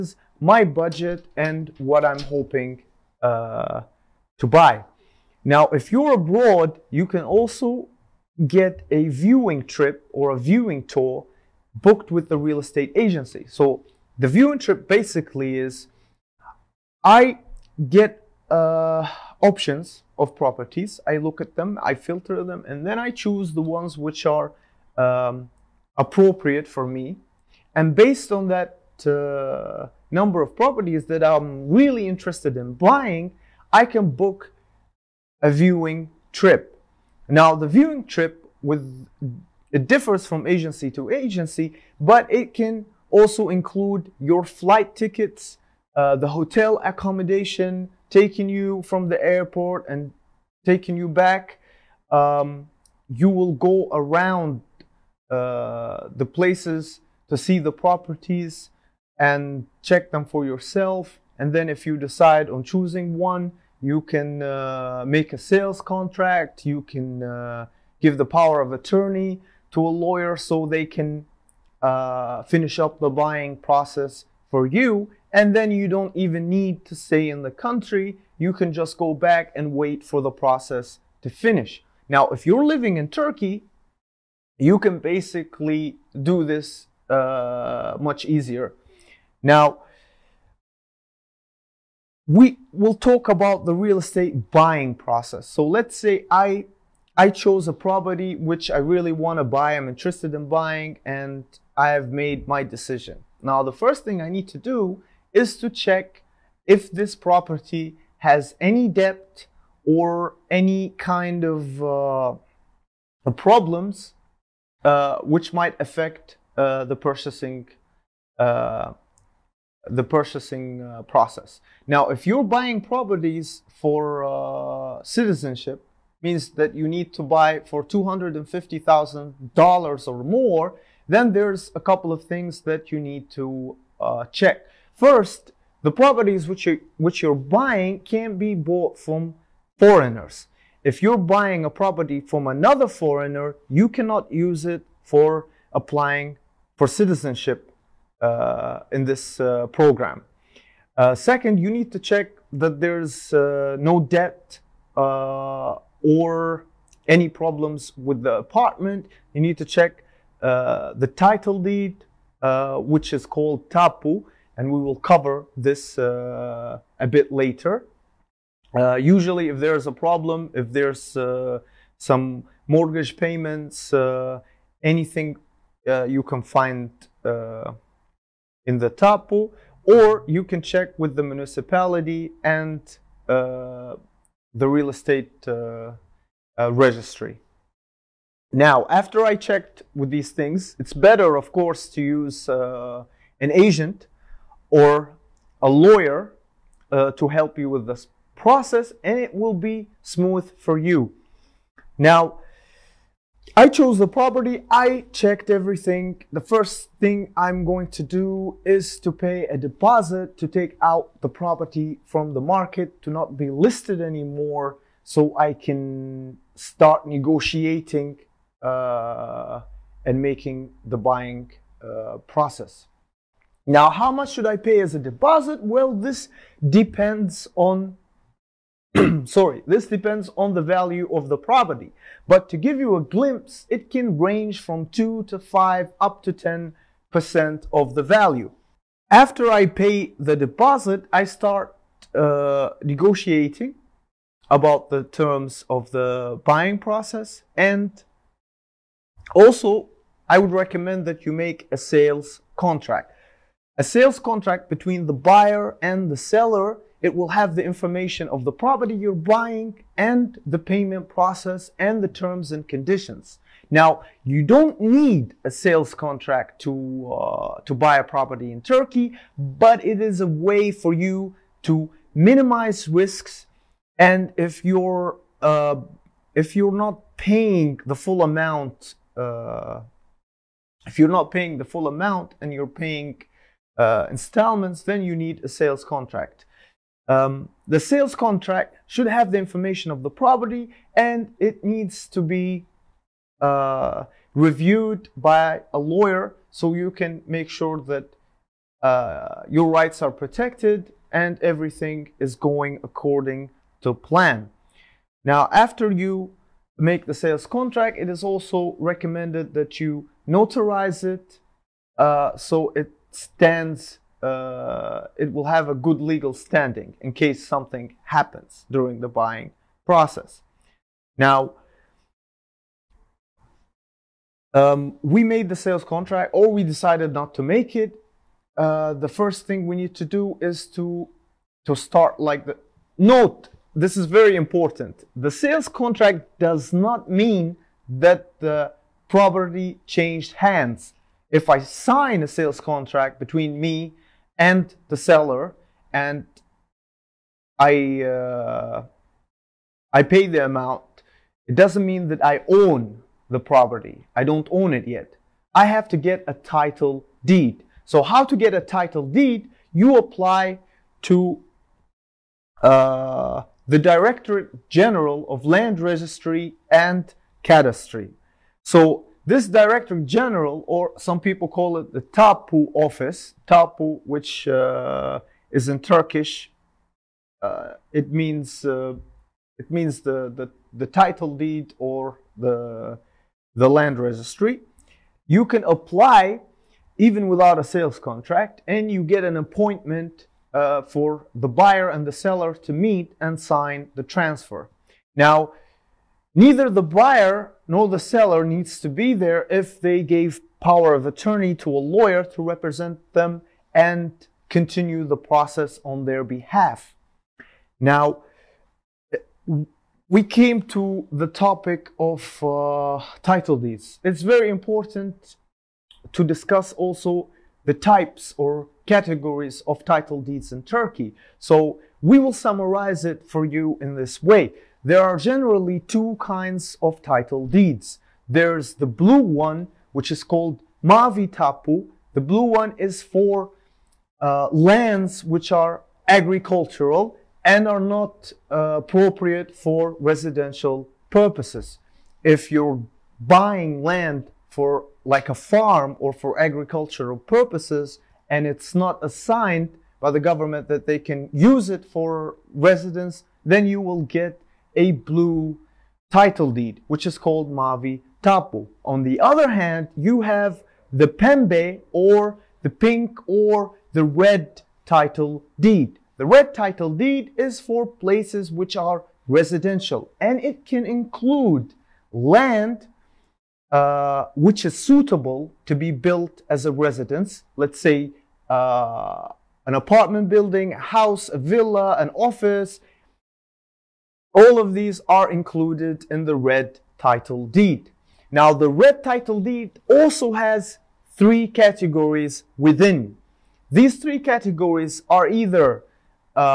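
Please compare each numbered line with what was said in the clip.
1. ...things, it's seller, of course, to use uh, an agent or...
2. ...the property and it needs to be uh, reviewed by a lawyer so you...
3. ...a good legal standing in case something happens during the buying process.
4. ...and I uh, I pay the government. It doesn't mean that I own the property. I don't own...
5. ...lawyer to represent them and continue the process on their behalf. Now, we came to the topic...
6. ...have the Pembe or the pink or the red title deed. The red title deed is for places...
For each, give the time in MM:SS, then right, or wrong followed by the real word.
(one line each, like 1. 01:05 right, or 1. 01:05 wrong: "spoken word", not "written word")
1. 03:10 wrong: "better", not "seller"
2. 04:50 right
3. 05:15 right
4. 05:45 wrong: "amount", not "government"
5. 06:41 right
6. 07:40 right.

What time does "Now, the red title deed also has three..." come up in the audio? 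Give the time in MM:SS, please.
08:08.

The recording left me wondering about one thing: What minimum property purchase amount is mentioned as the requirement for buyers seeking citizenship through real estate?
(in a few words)
$250,000.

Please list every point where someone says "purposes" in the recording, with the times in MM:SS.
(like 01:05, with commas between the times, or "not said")
07:21, 07:27.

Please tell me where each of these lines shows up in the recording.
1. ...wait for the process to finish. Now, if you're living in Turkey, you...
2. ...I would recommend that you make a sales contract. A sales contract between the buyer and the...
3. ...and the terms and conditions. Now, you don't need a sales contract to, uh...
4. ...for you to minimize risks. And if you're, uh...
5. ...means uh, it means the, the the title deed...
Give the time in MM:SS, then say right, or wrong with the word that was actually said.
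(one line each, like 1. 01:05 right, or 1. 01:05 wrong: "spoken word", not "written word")
1. 01:19 right
2. 04:10 right
3. 04:21 right
4. 04:30 right
5. 06:18 right.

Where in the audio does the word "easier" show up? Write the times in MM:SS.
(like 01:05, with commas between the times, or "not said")
01:28.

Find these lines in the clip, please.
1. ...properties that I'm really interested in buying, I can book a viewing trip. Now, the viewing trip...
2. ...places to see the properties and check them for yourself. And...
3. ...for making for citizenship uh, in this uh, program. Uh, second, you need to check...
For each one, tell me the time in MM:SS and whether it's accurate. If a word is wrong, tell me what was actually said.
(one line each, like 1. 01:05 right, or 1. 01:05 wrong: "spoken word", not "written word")
1. 00:30 right
2. 00:56 right
3. 02:25 wrong: "applying", not "making".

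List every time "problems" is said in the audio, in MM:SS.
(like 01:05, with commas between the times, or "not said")
01:53, 02:37, 02:49.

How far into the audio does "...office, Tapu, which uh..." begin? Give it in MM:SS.
06:12.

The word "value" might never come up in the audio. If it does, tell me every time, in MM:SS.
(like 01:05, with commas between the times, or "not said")
03:50, 03:58.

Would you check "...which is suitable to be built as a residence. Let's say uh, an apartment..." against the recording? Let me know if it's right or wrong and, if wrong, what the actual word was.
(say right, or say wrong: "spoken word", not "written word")
right.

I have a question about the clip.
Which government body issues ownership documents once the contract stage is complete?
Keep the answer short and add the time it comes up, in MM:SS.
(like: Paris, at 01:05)
Directorate General of Land Registry and Cadastry, at 06:03.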